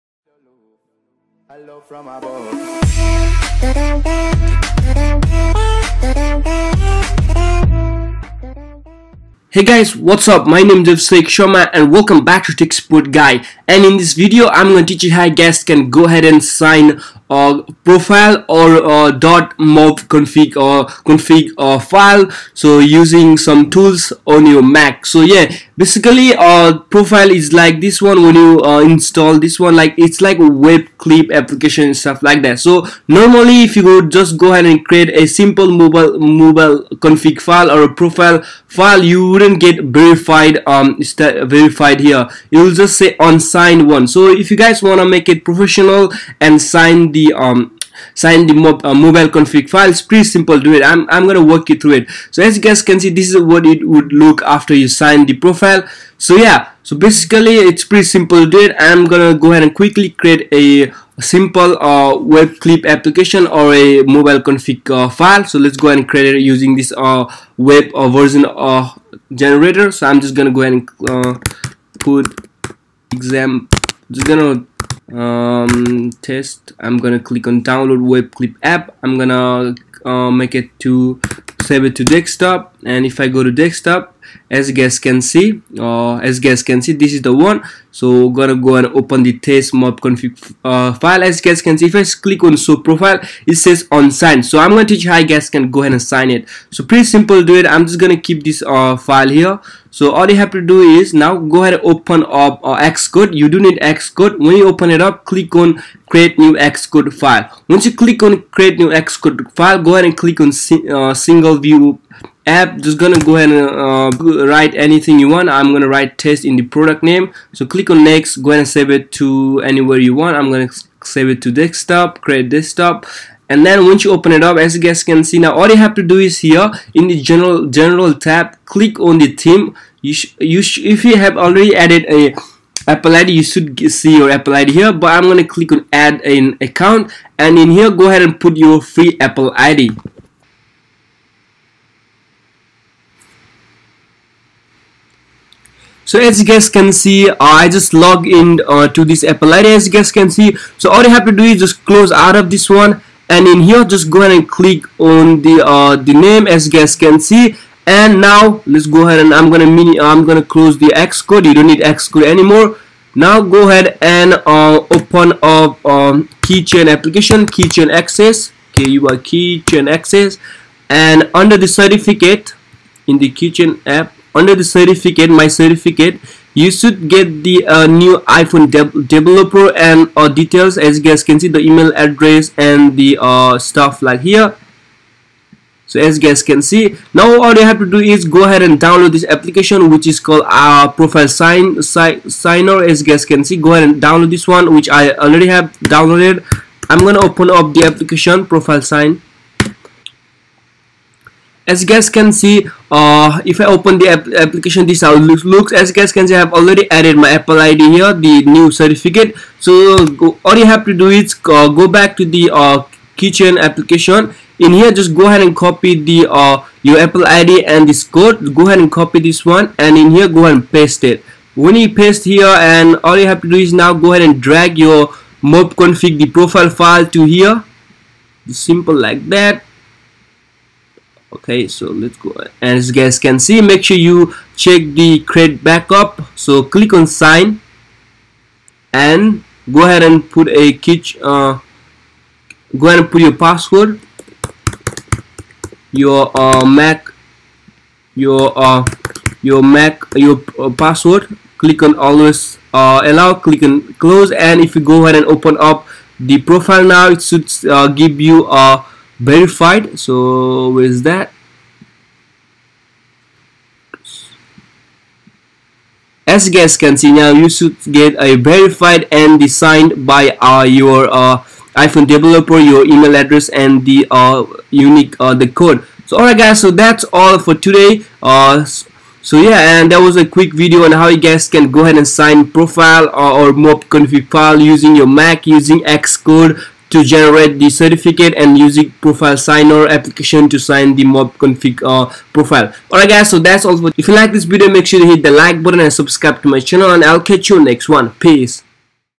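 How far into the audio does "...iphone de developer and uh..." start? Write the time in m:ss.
2:58.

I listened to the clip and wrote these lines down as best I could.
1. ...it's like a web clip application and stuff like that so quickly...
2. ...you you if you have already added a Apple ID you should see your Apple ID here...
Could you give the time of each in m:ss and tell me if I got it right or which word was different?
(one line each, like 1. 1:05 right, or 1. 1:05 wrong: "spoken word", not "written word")
1. 0:29 wrong: "normally", not "quickly"
2. 2:10 right.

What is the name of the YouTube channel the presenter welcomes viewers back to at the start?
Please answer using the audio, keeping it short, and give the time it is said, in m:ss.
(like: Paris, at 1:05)
TechSpot Guy, at 0:12.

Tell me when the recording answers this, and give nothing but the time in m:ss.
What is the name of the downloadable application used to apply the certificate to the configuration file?
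3:10.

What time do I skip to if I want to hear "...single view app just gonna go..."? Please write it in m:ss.
1:51.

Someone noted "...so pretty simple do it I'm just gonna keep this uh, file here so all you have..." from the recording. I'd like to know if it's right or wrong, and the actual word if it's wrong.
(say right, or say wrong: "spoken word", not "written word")
right.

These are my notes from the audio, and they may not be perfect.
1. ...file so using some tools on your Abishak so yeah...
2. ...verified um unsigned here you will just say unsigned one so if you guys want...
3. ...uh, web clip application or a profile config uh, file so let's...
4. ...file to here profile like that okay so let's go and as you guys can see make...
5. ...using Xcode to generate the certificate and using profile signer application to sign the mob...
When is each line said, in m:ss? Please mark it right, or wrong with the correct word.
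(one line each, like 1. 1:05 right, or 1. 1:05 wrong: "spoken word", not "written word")
1. 0:21 wrong: "Mac", not "Abishak"
2. 0:39 wrong: "verified", not "unsigned"
3. 1:01 wrong: "mobile", not "profile"
4. 3:46 wrong: "simple", not "profile"
5. 4:45 right.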